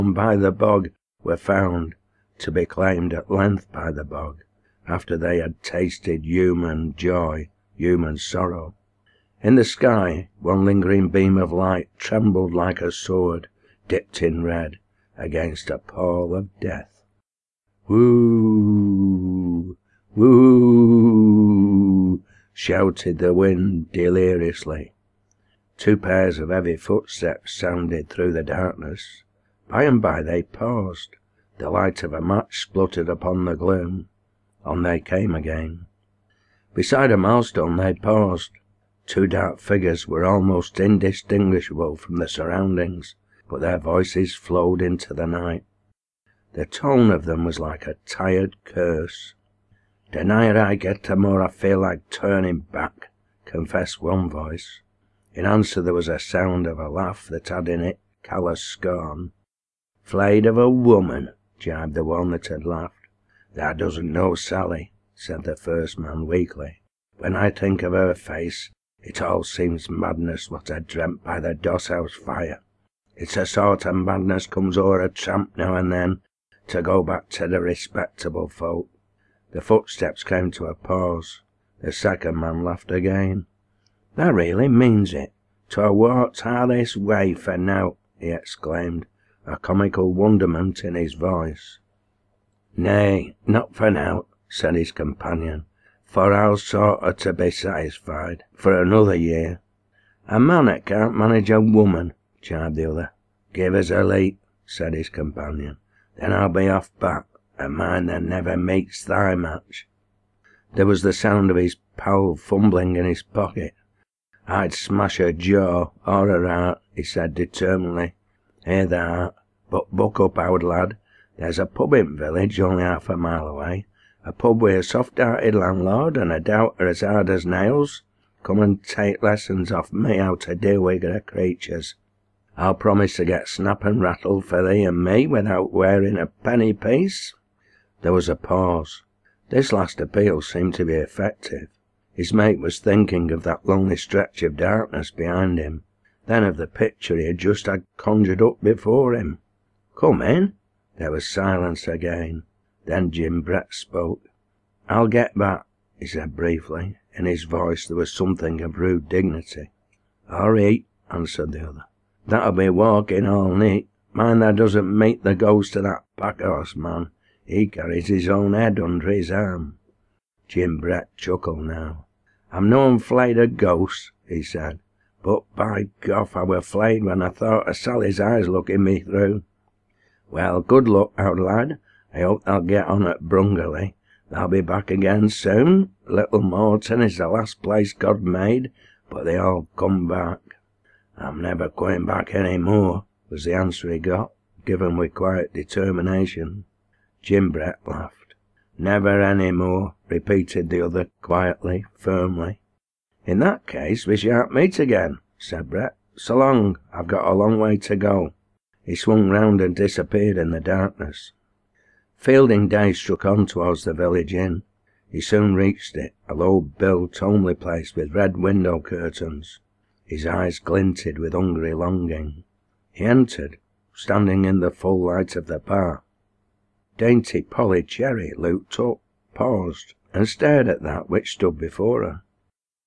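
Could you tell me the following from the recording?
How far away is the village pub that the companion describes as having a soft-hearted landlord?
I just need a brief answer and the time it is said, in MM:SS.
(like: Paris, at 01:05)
half a mile, at 02:02.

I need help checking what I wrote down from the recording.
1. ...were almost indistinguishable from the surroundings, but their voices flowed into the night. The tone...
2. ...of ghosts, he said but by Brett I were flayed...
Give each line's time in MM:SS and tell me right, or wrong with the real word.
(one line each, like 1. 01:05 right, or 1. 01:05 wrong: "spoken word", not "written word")
1. 00:40 right
2. 02:53 wrong: "Gough", not "Brett".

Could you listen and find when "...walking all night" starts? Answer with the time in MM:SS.
02:42.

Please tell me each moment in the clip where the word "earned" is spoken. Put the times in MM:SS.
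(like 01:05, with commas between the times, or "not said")
not said.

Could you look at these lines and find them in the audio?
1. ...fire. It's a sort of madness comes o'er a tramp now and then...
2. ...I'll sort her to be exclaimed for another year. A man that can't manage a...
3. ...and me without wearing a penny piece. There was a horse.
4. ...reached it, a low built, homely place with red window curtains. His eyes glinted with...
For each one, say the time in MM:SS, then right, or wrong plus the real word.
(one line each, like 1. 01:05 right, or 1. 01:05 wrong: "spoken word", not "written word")
1. 01:12 right
2. 01:36 wrong: "satisfied", not "exclaimed"
3. 02:14 wrong: "pause", not "horse"
4. 03:35 right.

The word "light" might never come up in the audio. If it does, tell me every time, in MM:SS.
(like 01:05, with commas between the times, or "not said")
00:11, 00:31, 03:45.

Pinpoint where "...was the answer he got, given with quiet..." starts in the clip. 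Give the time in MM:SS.
03:13.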